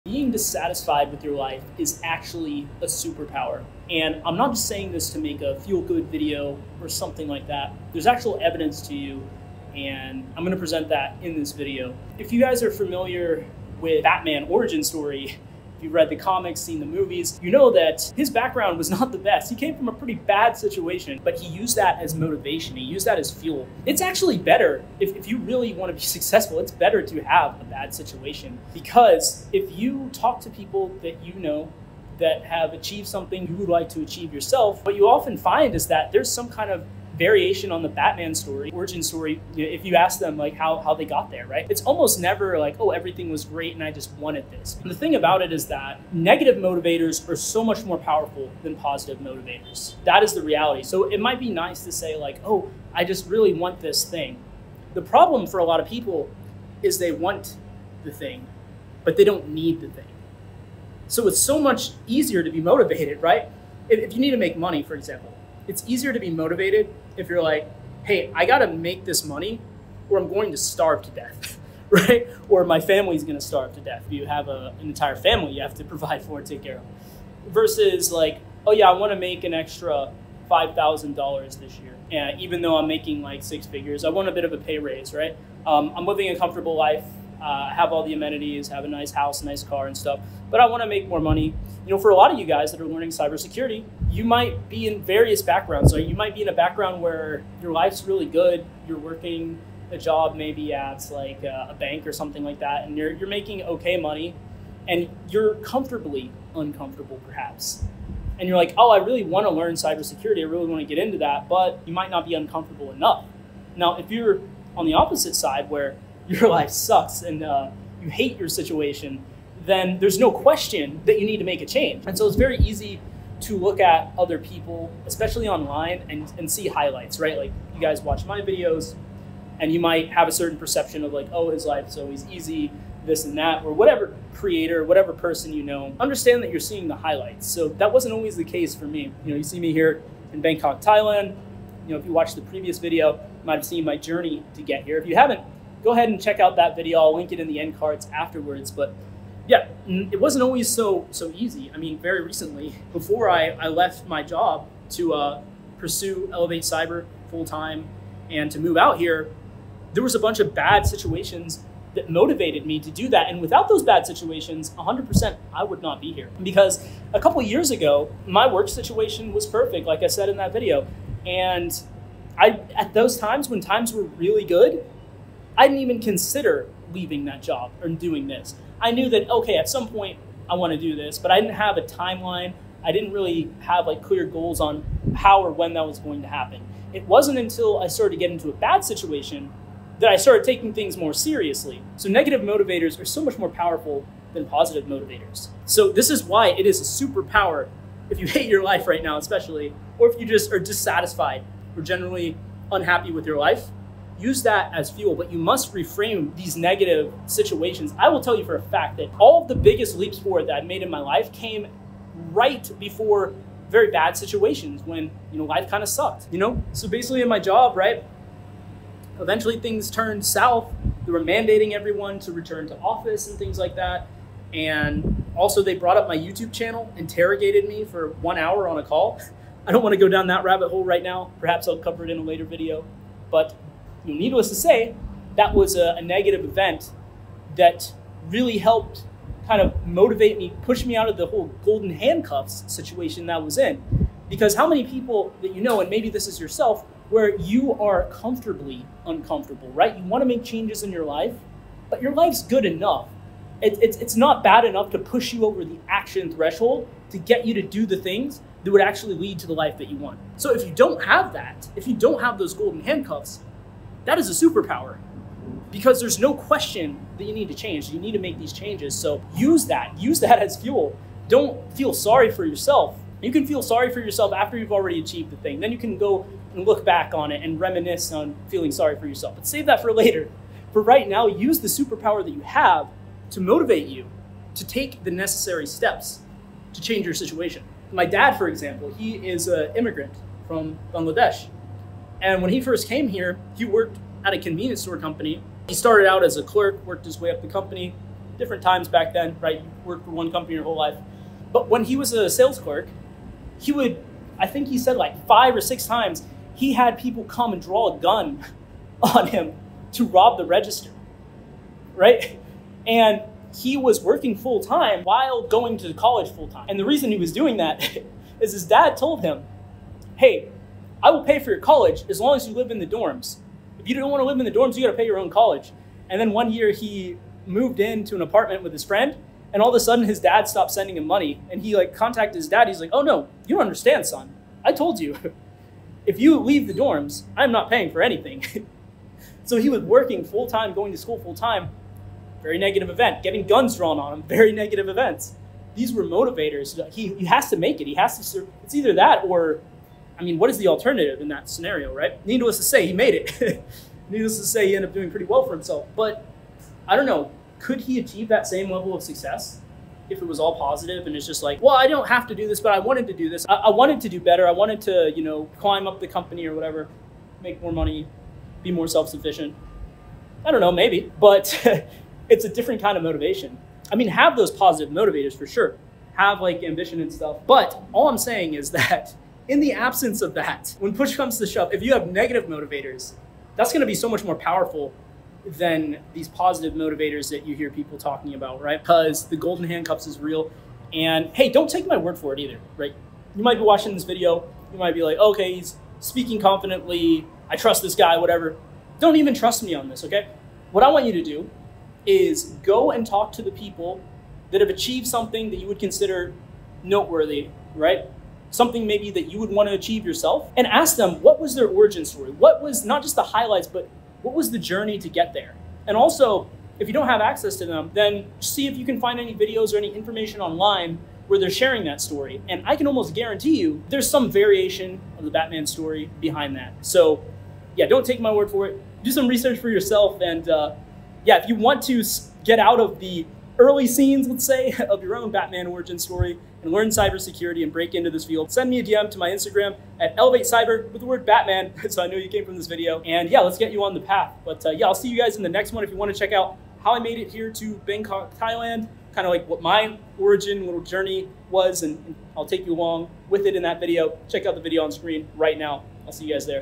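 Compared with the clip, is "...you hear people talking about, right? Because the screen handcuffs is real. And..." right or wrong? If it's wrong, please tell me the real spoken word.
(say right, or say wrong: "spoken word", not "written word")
wrong: "golden", not "screen".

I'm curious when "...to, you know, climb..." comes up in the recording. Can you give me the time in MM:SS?
06:04.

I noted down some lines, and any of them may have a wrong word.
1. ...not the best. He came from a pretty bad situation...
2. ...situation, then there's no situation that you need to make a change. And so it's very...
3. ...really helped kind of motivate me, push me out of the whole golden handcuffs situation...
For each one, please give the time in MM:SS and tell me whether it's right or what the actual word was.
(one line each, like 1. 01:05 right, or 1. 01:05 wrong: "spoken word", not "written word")
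1. 00:18 right
2. 01:58 wrong: "question", not "situation"
3. 03:58 right.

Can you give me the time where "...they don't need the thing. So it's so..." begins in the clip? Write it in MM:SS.
00:59.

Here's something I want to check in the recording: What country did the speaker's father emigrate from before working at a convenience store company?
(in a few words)
Bangladesh.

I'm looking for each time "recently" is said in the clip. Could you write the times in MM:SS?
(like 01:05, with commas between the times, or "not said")
02:32.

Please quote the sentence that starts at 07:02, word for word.
And I can almost guarantee you there's some variation of the Batman story behind that.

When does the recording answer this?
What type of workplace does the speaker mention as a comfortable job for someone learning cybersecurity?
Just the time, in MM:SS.
01:41.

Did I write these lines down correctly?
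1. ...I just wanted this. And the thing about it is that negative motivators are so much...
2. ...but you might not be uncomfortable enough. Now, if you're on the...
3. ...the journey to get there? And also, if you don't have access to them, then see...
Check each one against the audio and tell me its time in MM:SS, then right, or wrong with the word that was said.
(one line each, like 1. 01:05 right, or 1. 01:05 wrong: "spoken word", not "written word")
1. 00:43 right
2. 01:51 right
3. 06:54 right.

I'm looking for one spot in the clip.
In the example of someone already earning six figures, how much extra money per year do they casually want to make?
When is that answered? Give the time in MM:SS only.
01:20.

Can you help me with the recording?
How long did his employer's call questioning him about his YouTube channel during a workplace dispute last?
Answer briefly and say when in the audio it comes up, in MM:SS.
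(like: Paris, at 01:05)
one hour, at 03:48.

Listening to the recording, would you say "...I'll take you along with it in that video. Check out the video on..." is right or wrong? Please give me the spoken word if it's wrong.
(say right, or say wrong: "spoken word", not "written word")
right.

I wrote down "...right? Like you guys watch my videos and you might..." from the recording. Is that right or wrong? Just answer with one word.
right.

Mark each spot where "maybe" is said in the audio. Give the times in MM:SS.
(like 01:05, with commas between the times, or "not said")
01:40, 04:05, 06:10, 06:48.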